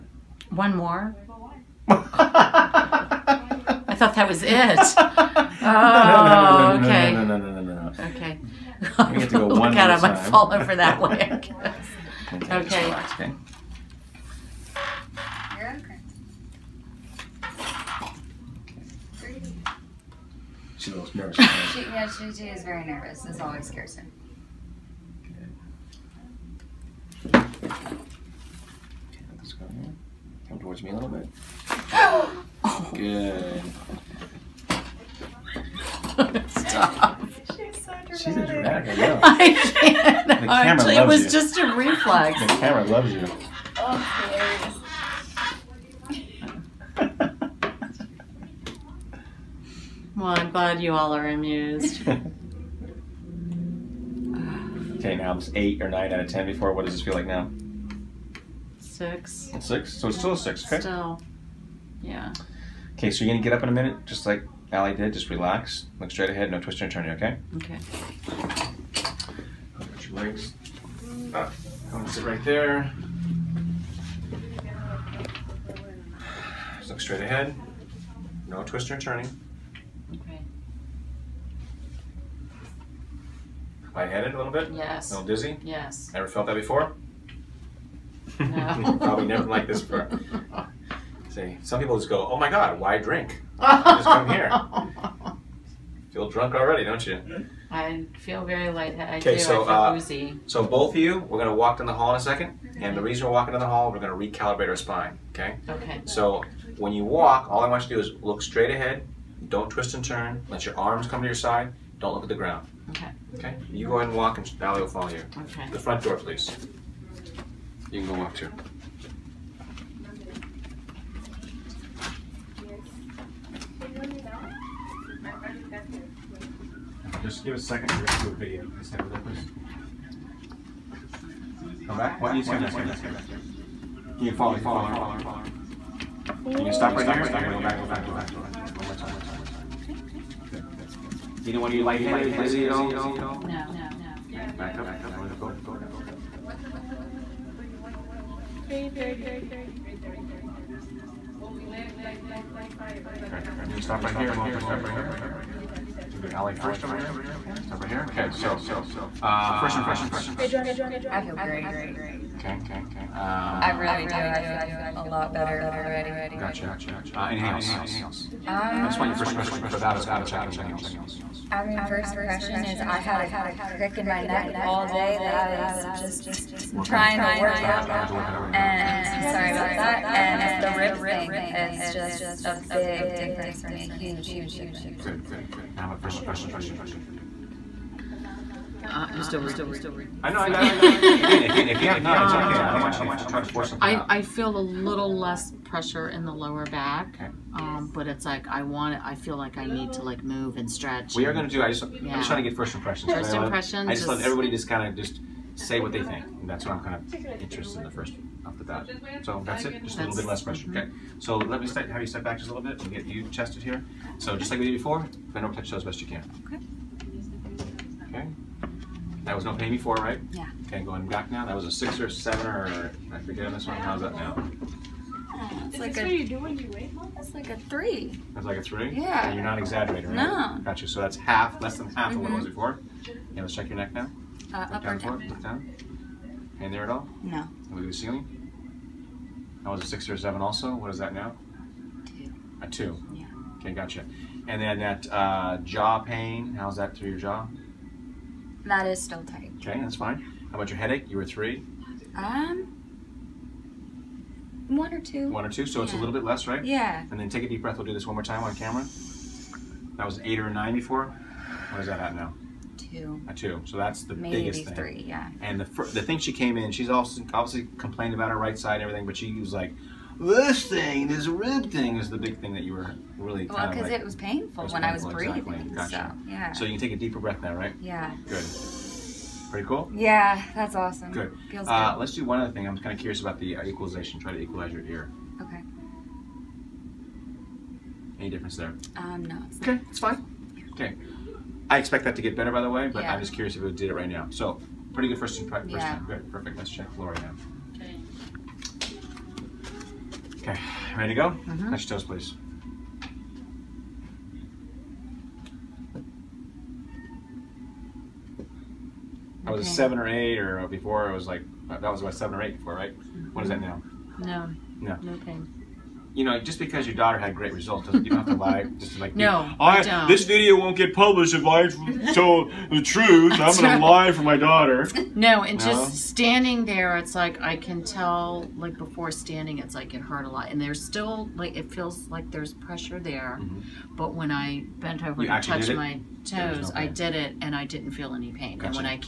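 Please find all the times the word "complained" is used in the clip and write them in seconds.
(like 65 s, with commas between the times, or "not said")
267 s.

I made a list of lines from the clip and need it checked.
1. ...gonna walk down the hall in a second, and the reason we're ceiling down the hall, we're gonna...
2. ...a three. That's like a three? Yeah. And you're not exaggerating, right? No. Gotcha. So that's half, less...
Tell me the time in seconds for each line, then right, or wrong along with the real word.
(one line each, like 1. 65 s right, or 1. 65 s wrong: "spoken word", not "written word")
1. 101 s wrong: "walking", not "ceiling"
2. 227 s right.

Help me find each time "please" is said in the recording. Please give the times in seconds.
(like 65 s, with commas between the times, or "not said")
116 s, 128 s, 302 s.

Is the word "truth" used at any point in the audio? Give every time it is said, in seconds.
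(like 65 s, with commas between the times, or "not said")
322 s.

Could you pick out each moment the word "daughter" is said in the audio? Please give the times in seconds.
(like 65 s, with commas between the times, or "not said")
316 s, 324 s.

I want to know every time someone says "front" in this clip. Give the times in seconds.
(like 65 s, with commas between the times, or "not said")
115 s, 137 s.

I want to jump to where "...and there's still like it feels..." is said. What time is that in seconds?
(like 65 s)
330 s.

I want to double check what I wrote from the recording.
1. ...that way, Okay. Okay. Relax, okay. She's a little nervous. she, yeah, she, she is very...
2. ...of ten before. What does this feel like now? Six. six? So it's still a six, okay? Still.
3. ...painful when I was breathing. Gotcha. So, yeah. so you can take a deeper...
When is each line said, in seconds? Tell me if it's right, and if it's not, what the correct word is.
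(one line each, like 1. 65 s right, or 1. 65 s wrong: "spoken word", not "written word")
1. 10 s right
2. 56 s right
3. 274 s right.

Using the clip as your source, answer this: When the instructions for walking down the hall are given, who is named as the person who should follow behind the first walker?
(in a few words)
Sally.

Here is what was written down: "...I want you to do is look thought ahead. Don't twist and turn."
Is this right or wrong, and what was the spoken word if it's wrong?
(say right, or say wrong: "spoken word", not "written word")
wrong: "straight", not "thought".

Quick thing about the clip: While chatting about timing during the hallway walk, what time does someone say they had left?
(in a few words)
4:45.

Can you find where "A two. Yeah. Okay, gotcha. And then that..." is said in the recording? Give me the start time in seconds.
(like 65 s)
242 s.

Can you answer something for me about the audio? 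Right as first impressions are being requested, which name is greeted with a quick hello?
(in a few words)
Joanna.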